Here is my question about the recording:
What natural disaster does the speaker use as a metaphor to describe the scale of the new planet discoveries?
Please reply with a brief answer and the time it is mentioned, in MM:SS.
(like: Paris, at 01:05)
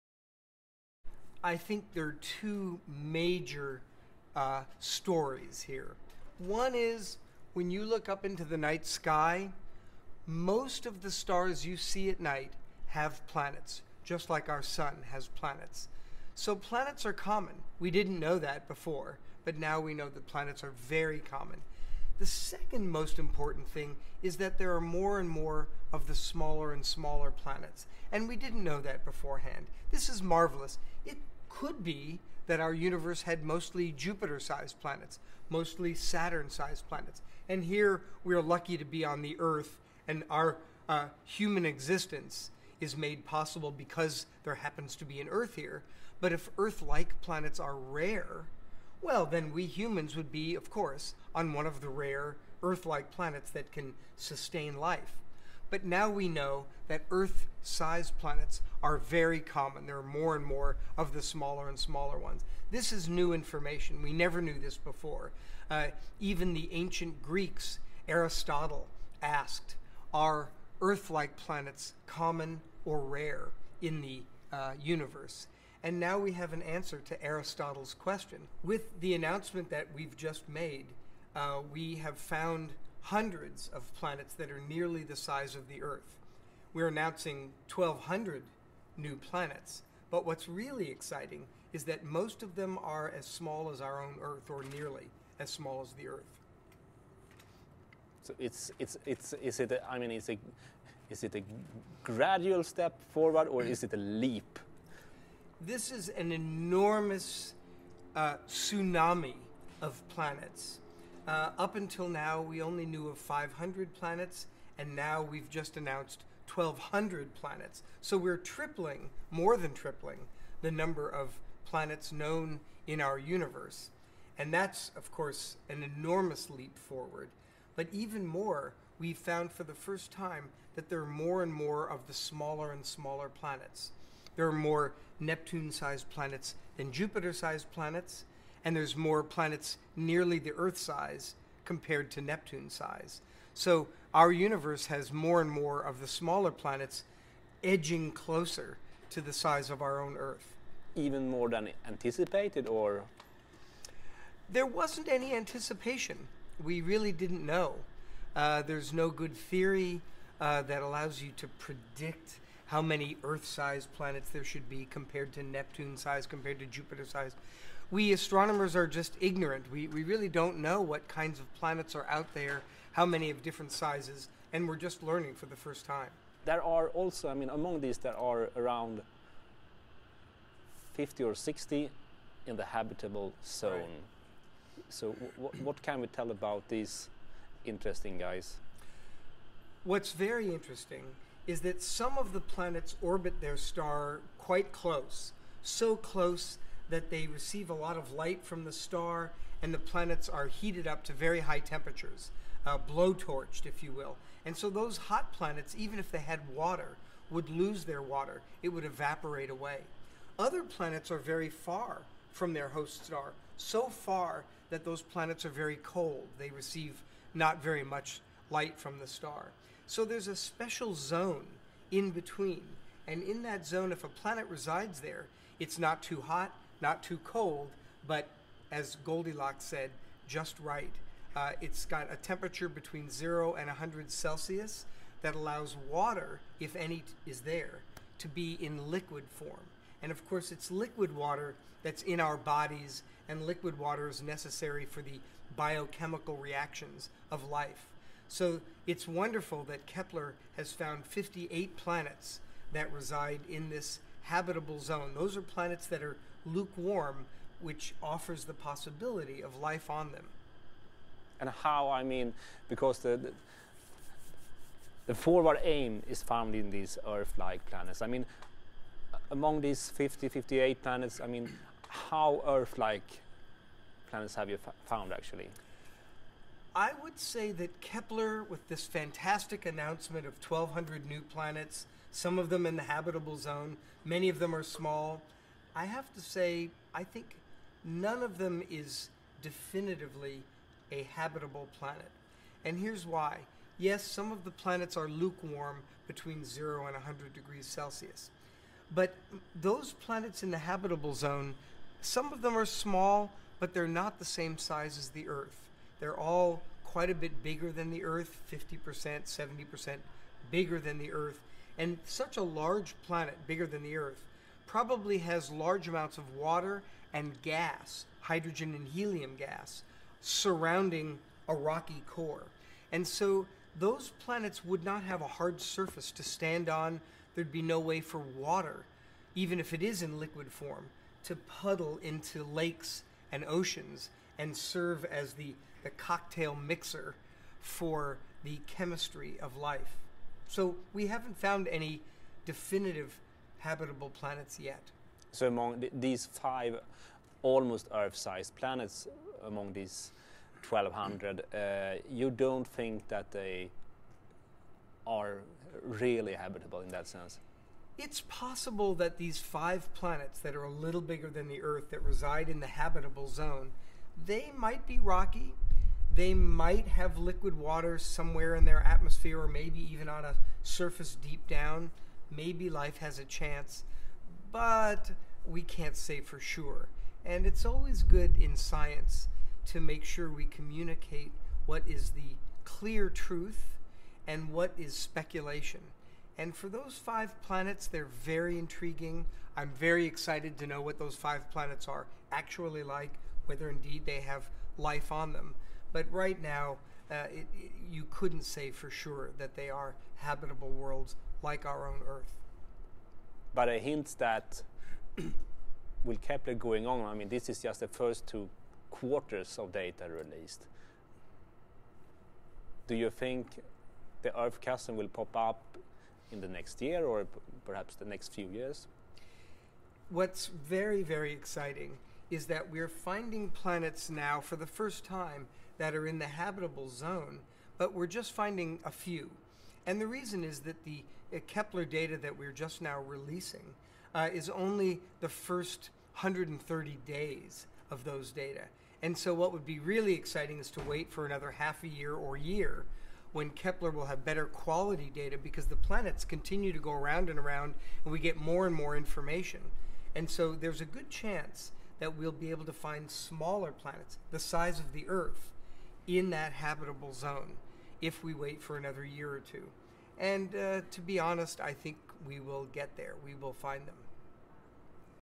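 tsunami, at 01:48.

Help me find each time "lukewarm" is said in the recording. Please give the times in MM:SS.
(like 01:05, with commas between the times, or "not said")
04:16, 04:55.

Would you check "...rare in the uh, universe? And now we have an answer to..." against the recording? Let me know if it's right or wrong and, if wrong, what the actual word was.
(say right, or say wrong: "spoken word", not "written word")
right.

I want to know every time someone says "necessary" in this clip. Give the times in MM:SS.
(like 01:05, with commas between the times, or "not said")
04:04.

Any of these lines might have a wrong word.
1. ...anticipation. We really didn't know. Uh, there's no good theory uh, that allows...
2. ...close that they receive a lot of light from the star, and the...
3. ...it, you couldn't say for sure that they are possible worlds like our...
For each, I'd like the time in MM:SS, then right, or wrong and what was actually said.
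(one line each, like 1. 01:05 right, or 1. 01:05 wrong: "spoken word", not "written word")
1. 02:35 right
2. 03:15 right
3. 06:37 wrong: "habitable", not "possible".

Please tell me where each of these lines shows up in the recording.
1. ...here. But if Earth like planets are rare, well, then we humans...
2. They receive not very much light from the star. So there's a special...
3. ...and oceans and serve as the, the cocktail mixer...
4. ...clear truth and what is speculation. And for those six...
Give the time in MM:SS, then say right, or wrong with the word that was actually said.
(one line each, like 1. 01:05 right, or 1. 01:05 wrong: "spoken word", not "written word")
1. 00:45 right
2. 03:36 right
3. 05:33 right
4. 06:22 wrong: "five", not "six".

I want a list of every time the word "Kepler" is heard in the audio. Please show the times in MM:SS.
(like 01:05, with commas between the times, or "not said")
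04:09, 04:37, 06:46, 07:11, 07:23.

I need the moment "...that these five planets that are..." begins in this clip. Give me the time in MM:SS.
05:59.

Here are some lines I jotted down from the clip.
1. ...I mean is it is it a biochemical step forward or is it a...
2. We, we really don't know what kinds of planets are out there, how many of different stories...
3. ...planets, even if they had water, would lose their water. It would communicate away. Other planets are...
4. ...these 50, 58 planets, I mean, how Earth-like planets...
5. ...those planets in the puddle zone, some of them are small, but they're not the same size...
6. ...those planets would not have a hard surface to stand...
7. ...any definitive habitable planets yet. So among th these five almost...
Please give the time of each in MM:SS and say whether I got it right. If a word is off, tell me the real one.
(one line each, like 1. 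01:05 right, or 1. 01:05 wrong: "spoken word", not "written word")
1. 01:39 wrong: "gradual", not "biochemical"
2. 02:49 wrong: "sizes", not "stories"
3. 03:25 wrong: "evaporate", not "communicate"
4. 04:29 right
5. 04:59 wrong: "habitable", not "puddle"
6. 05:23 right
7. 05:41 right.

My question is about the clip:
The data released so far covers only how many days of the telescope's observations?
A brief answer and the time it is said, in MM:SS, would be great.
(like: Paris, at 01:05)
130 days, at 07:16.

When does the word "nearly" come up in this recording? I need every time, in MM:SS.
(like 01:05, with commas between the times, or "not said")
01:24, 01:34, 02:19.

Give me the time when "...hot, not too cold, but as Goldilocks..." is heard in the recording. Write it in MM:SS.
03:46.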